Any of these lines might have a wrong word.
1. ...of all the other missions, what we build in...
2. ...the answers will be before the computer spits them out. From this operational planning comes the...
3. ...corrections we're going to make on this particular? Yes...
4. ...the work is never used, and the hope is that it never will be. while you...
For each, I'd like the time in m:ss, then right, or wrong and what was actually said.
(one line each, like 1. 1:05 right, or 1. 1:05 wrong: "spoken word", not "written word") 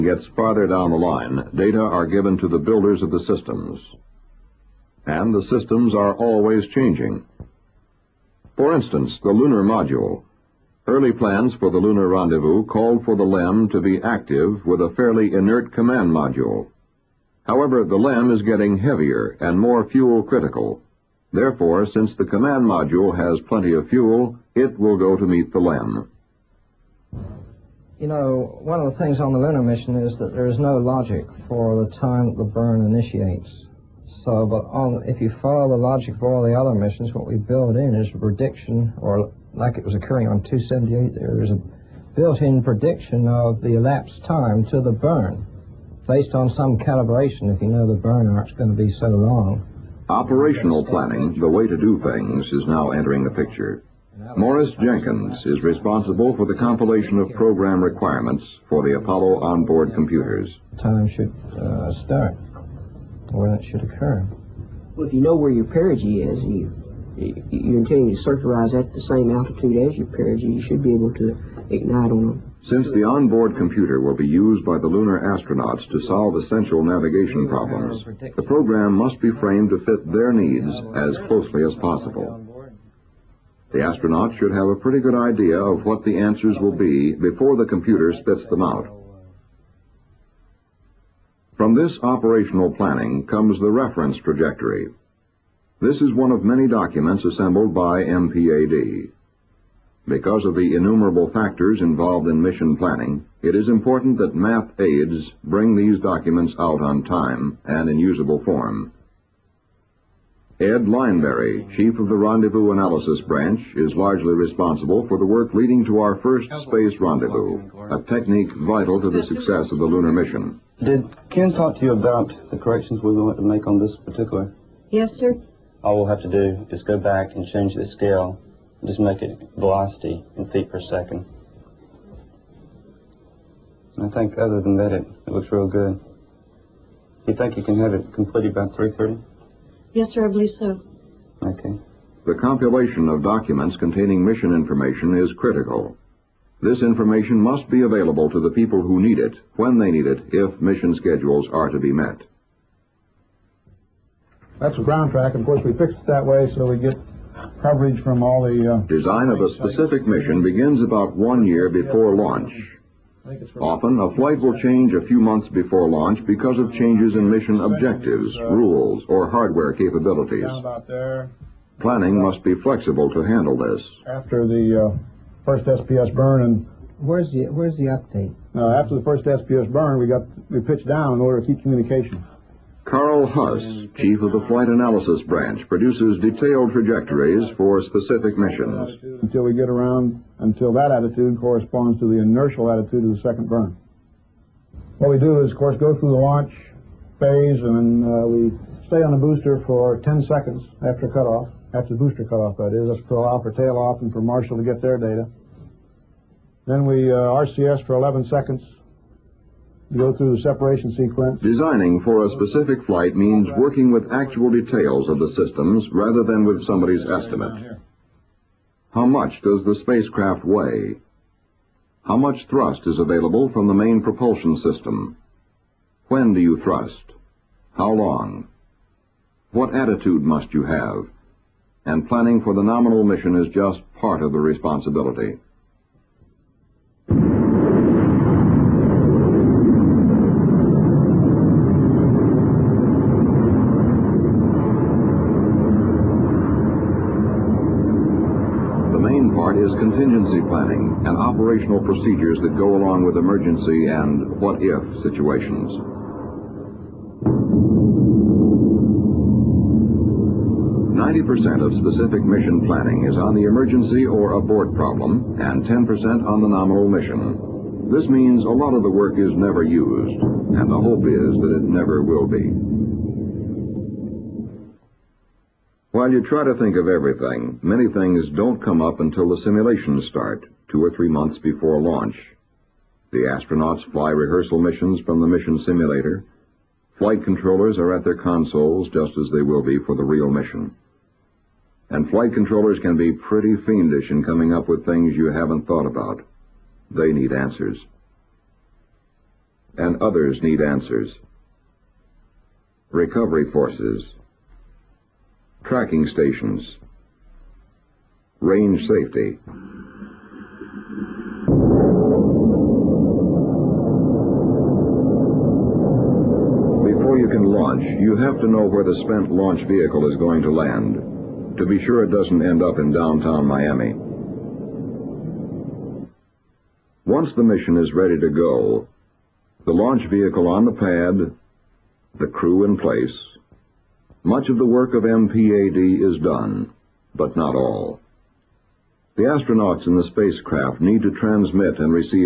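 1. 0:36 right
2. 1:26 right
3. 2:02 right
4. 4:28 right.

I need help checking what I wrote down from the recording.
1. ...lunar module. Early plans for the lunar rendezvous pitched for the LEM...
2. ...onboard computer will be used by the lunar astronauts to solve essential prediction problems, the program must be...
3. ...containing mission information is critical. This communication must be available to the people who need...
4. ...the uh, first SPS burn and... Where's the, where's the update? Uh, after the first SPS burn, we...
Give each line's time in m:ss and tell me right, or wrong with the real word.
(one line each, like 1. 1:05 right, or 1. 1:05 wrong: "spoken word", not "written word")
1. 0:09 wrong: "called", not "pitched"
2. 1:13 wrong: "navigation", not "prediction"
3. 2:23 wrong: "information", not "communication"
4. 2:54 right.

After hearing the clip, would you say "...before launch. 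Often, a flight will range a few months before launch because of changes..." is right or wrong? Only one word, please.
wrong.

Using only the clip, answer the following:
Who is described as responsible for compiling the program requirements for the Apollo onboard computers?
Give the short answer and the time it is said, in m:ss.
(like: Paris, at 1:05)
Morris Jenkins, at 0:54.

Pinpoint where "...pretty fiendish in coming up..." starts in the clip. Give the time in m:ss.
4:53.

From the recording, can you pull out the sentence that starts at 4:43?
The astronauts fly rehearsal missions from the mission simulator.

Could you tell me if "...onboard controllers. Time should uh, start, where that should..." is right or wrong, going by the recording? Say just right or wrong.
wrong.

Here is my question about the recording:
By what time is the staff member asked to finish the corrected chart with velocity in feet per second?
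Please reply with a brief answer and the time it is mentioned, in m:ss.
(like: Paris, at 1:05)
3:30, at 2:18.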